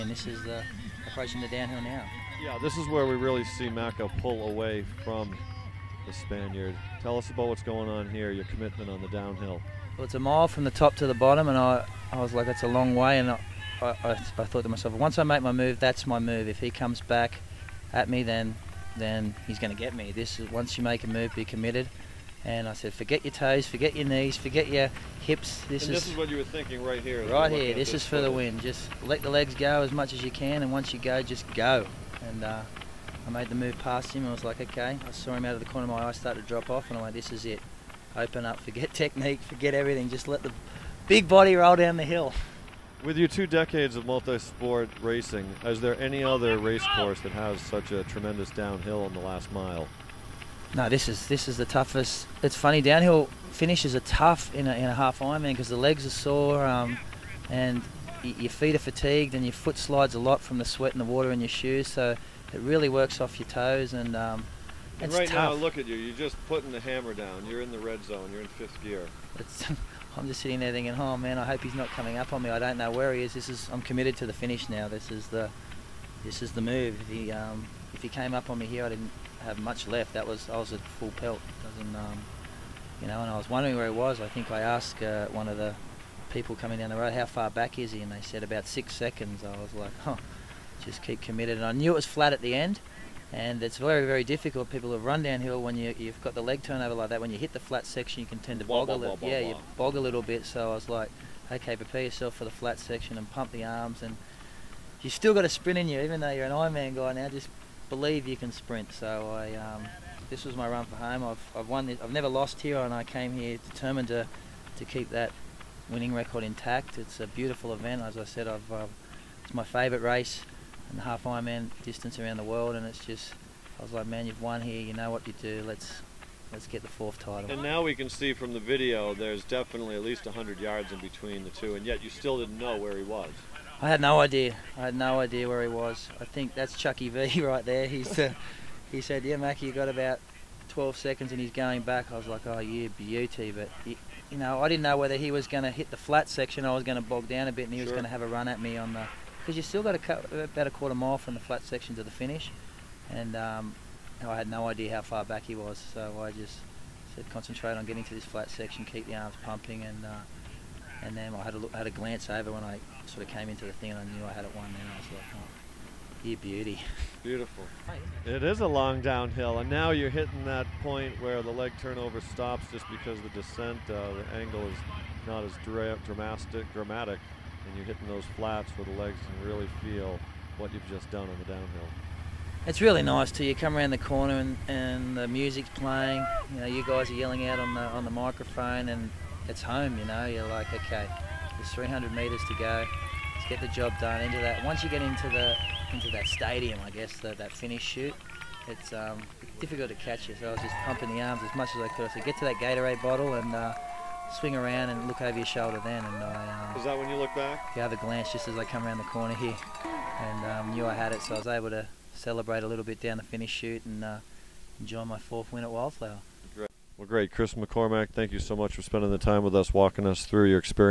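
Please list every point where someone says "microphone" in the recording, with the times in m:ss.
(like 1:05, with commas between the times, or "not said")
3:08.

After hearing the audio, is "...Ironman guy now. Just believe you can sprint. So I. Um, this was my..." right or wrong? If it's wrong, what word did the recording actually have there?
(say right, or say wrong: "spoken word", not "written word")
right.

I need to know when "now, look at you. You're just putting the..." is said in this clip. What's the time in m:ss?
1:05.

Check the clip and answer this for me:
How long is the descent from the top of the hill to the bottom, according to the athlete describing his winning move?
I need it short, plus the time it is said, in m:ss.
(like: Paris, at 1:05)
a mile, at 0:10.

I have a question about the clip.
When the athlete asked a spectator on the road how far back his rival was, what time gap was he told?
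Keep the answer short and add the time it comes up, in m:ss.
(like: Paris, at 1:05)
6 seconds, at 1:28.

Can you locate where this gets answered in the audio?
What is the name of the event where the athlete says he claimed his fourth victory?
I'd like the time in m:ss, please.
3:35.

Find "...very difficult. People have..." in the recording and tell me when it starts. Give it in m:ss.
1:34.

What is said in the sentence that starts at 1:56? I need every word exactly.
It's a beautiful event, as I said.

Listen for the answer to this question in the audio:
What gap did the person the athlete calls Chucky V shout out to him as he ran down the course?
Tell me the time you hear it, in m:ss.
2:19.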